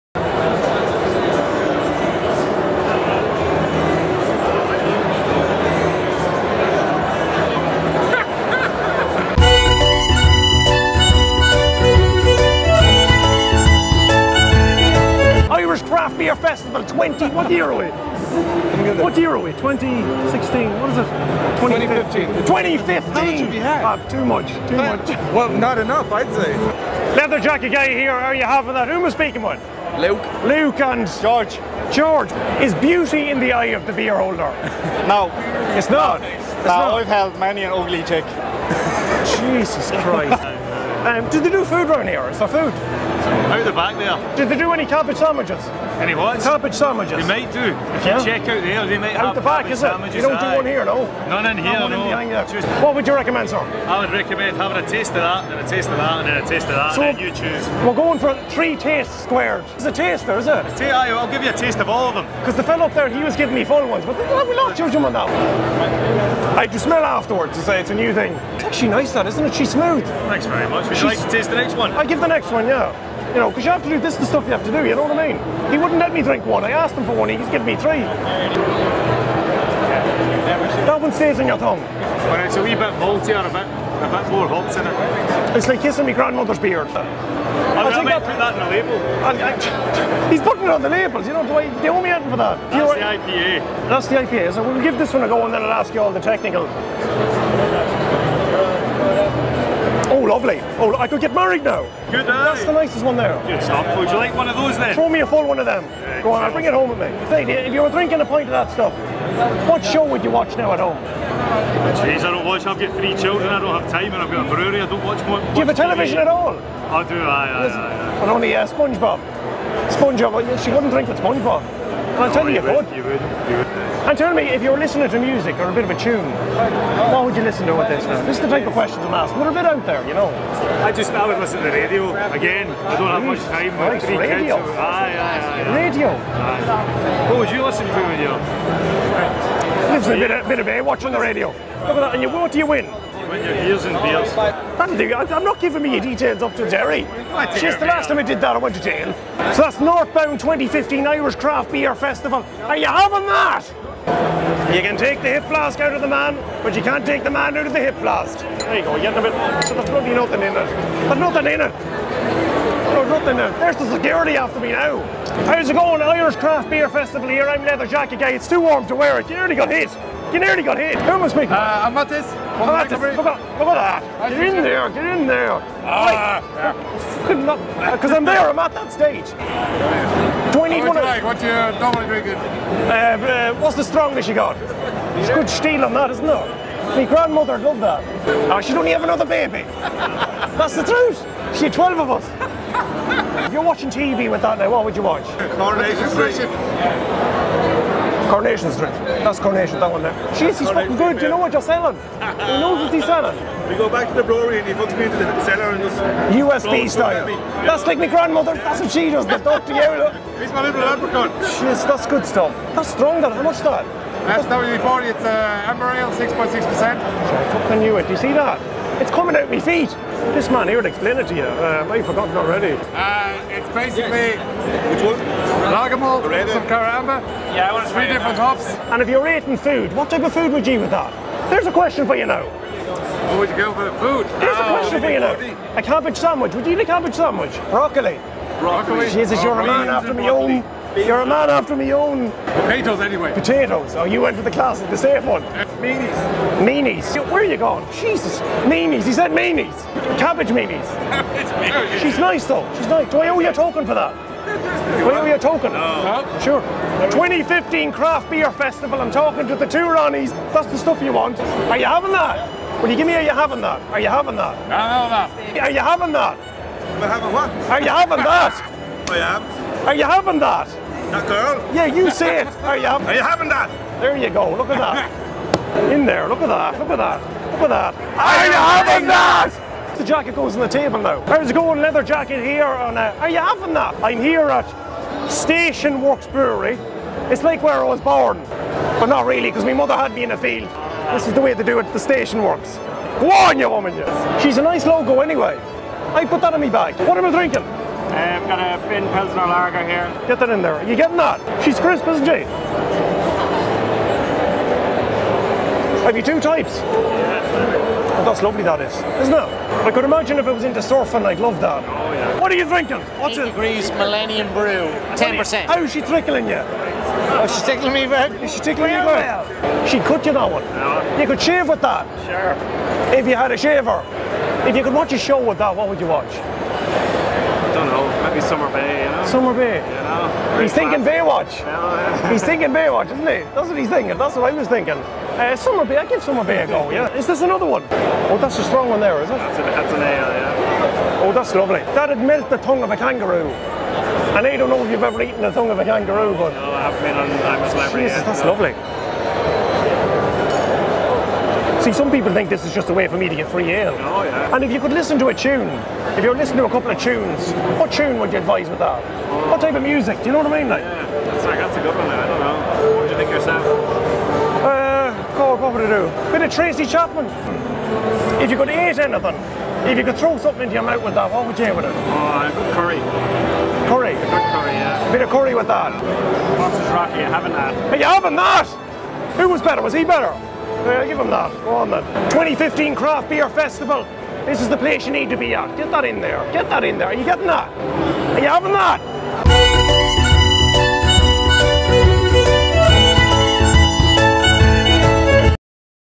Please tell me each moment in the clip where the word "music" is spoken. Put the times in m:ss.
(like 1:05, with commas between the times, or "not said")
2:05, 5:59.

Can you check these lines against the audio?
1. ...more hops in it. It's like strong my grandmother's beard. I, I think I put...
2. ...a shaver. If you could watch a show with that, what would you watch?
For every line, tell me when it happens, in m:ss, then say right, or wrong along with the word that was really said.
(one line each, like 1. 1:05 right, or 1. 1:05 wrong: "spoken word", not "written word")
1. 1:24 wrong: "kissing", not "strong"
2. 5:23 right.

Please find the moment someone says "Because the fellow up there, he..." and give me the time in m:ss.
1:02.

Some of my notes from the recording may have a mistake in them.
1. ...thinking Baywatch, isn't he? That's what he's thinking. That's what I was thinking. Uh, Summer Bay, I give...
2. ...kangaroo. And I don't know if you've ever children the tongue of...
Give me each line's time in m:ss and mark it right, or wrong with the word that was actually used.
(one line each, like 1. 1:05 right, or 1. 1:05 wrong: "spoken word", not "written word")
1. 5:32 right
2. 5:42 wrong: "eaten", not "children".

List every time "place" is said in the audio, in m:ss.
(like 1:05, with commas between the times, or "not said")
6:24.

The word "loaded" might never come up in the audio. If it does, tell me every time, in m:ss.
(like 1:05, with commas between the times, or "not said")
not said.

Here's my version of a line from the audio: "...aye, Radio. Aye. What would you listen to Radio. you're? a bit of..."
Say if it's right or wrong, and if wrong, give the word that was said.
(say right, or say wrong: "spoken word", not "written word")
right.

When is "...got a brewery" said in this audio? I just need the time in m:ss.
1:54.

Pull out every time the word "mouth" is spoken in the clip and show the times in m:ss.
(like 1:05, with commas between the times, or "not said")
6:10.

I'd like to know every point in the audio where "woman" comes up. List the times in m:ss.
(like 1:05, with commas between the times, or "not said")
4:53.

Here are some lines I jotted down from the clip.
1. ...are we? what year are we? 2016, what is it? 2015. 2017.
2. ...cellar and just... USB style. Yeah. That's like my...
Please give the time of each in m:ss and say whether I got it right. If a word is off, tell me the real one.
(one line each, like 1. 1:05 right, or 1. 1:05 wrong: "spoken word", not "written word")
1. 0:17 wrong: "2015", not "2017"
2. 3:25 right.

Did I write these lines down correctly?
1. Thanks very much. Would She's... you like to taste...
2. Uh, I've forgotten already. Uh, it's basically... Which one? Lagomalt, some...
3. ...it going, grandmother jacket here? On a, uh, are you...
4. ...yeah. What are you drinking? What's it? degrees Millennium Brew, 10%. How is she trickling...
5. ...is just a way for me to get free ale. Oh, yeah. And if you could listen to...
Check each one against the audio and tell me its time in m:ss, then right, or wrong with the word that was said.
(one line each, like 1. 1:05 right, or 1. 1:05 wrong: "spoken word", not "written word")
1. 1:10 right
2. 3:41 right
3. 4:41 wrong: "leather", not "grandmother"
4. 5:12 right
5. 5:52 right.